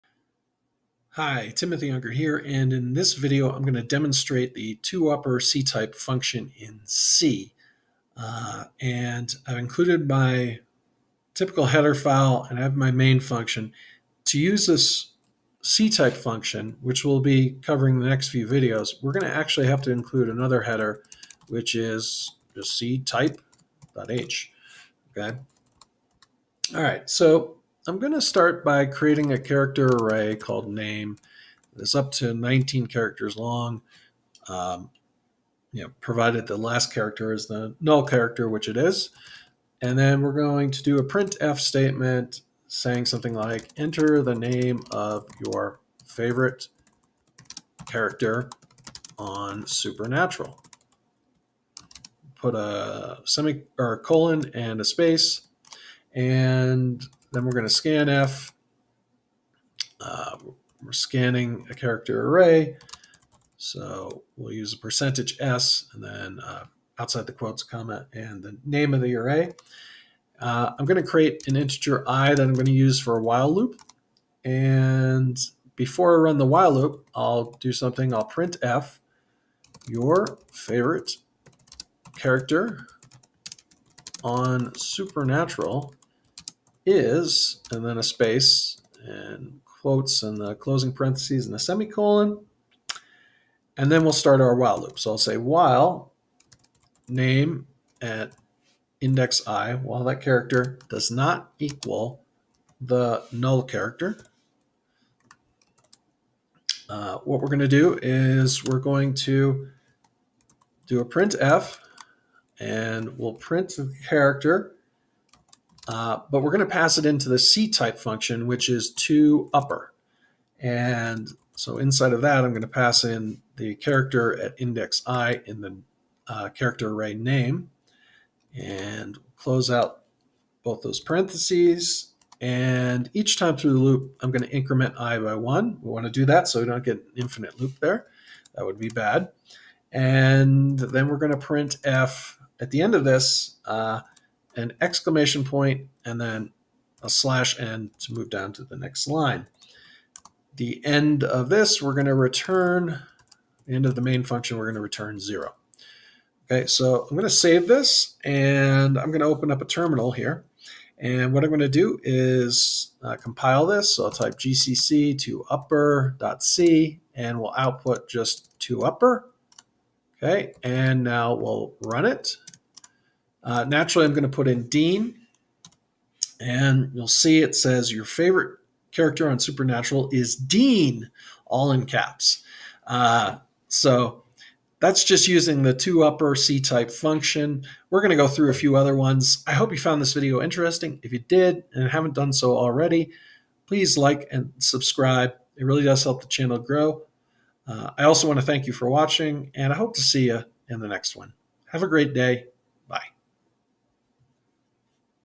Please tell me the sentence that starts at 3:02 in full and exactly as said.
Uh, so that's just using the toupper C type function.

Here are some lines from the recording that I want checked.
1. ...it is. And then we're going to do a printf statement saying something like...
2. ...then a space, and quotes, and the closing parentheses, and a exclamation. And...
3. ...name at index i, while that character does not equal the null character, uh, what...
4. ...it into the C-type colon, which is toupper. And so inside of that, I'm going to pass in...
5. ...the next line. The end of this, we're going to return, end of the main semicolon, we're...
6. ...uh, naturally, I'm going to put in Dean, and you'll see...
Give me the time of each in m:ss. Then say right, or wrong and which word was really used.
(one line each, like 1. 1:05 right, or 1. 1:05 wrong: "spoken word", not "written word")
1. 0:38 right
2. 1:27 wrong: "semicolon", not "exclamation"
3. 1:37 right
4. 1:56 wrong: "function", not "colon"
5. 2:28 wrong: "function", not "semicolon"
6. 2:53 right.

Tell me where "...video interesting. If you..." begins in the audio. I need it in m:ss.
3:10.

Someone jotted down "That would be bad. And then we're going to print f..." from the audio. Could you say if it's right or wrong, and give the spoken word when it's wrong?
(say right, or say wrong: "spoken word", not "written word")
right.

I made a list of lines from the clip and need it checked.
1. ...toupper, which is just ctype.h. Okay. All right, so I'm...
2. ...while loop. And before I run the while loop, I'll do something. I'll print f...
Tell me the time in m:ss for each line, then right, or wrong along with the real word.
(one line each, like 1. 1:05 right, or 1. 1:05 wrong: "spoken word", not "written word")
1. 0:20 wrong: "header", not "toupper"
2. 1:13 right.